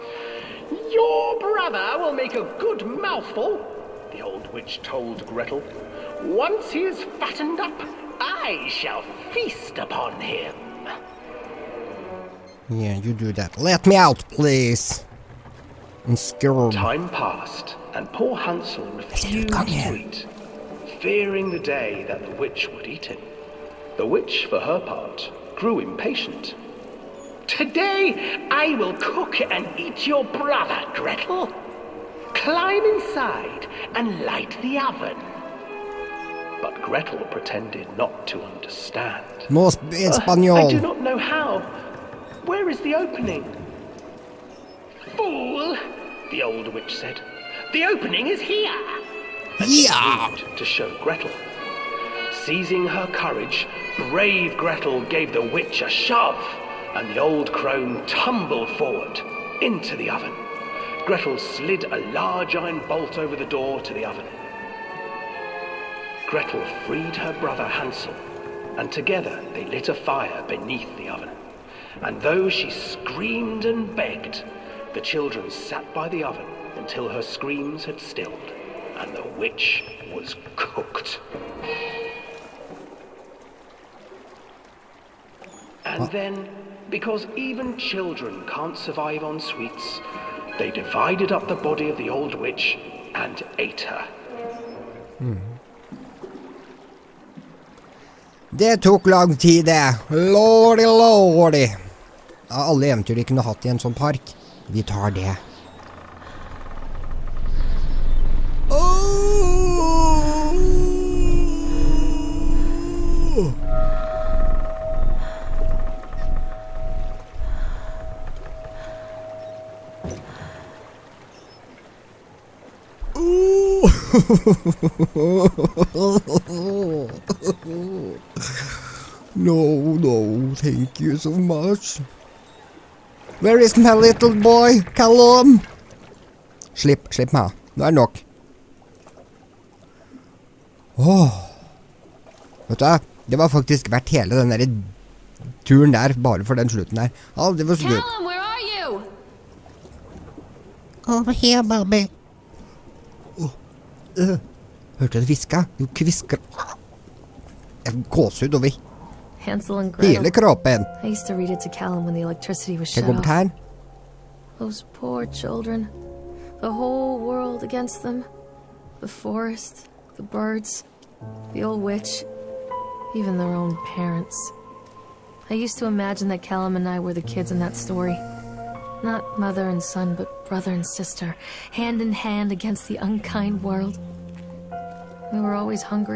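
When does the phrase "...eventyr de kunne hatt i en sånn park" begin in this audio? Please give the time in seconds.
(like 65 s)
102 s.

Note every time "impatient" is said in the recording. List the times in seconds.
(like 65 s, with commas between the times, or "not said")
25 s.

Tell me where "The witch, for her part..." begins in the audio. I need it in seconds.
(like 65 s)
23 s.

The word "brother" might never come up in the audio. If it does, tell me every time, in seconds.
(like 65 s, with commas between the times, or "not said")
1 s, 30 s, 67 s, 180 s.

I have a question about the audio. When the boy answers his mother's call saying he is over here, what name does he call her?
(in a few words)
Barbie.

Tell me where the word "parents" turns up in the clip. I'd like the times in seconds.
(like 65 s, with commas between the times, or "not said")
173 s.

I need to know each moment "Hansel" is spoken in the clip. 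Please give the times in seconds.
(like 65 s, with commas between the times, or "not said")
18 s, 67 s, 159 s.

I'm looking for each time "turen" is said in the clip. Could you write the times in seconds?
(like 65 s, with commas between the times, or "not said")
145 s.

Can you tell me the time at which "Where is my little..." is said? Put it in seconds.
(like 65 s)
133 s.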